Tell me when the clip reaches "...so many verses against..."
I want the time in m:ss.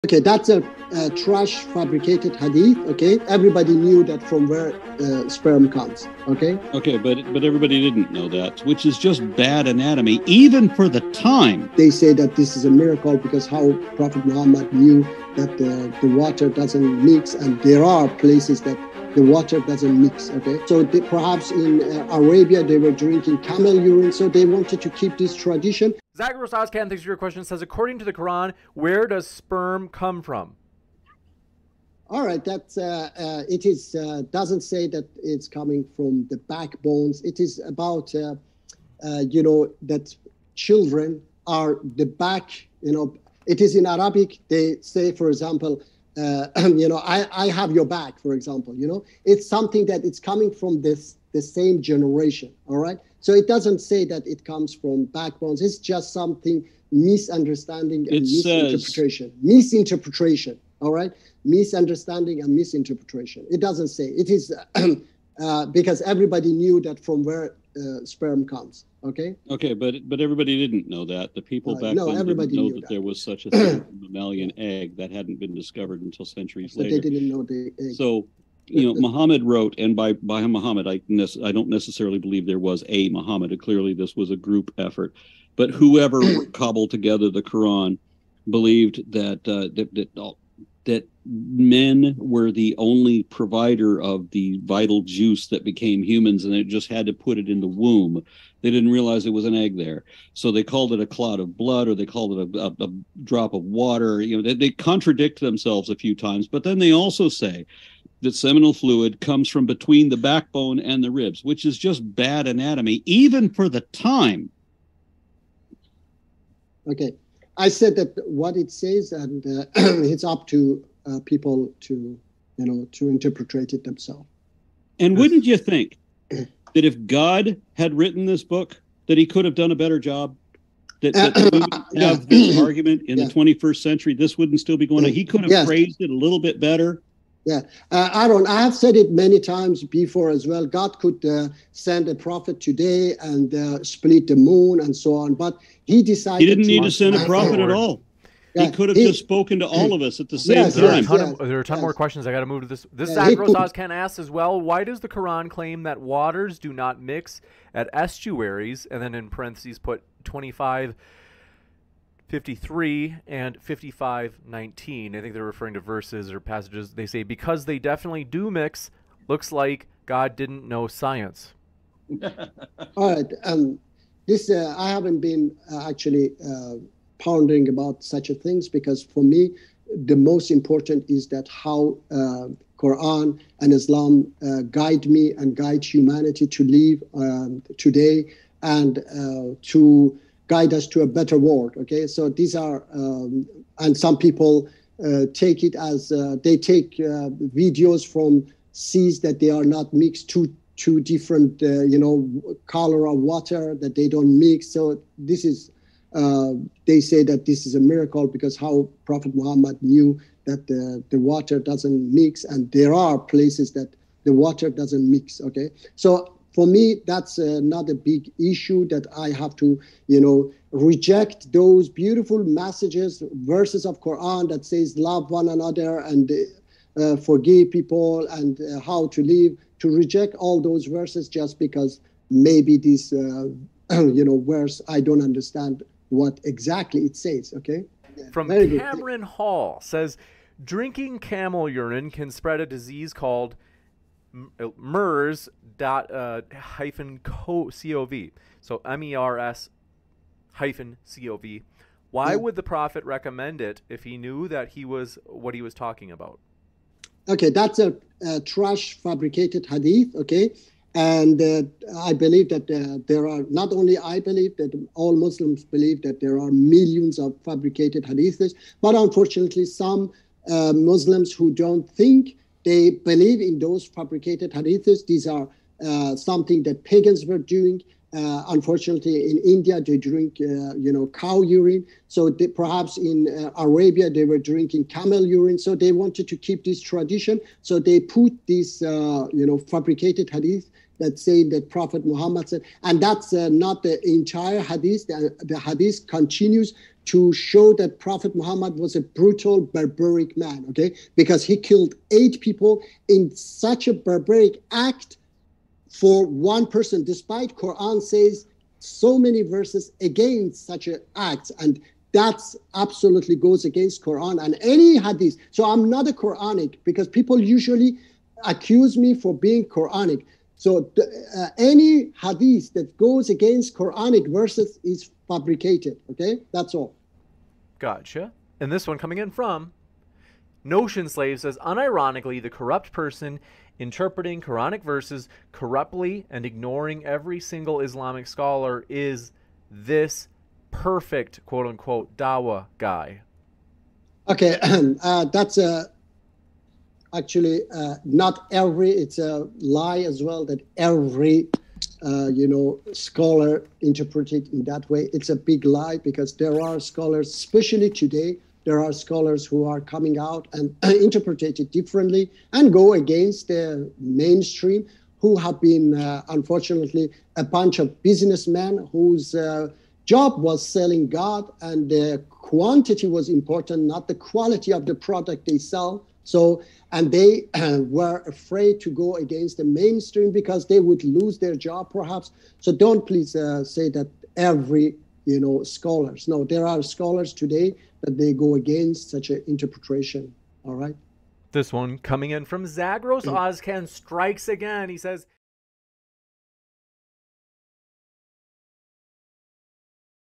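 5:08.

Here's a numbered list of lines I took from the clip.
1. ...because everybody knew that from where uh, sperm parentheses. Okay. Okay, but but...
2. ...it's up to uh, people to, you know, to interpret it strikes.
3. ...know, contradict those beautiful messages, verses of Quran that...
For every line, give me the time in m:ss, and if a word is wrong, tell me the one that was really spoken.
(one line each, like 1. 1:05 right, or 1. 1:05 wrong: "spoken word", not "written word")
1. 1:05 wrong: "comes", not "parentheses"
2. 1:59 wrong: "themselves", not "strikes"
3. 3:40 wrong: "reject", not "contradict".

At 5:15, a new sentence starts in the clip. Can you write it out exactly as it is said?
So I'm not a Quranic because people usually accuse me for being Quranic.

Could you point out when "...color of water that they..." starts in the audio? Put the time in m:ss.
3:22.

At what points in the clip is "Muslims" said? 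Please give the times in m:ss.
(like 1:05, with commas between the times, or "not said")
4:25, 4:30.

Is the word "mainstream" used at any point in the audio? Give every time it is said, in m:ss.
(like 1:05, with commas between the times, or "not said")
6:03, 6:19.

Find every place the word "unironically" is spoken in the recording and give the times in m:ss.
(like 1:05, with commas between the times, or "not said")
5:31.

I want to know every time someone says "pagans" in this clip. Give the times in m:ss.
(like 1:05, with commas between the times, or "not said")
4:36.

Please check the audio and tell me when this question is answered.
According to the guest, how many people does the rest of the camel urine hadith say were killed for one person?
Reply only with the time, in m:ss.
5:02.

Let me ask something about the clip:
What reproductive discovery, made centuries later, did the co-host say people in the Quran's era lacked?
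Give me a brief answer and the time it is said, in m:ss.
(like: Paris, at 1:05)
mammalian egg, at 1:13.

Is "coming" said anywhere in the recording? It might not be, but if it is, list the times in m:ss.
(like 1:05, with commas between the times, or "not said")
0:35, 0:50, 5:28, 5:59, 6:31.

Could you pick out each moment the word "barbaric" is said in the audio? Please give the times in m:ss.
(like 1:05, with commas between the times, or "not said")
4:59, 5:03.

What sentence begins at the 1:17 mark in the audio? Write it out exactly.
So you know, Muhammad wrote, and by by Muhammad, I ne- I don't necessarily believe there was a Muhammad.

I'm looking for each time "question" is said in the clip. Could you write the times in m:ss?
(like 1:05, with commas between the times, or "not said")
0:27, 2:31.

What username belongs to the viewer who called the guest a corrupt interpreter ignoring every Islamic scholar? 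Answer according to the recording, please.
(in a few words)
Notion Slave.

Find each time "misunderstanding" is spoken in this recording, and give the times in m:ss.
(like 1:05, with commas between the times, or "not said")
0:56, 1:01.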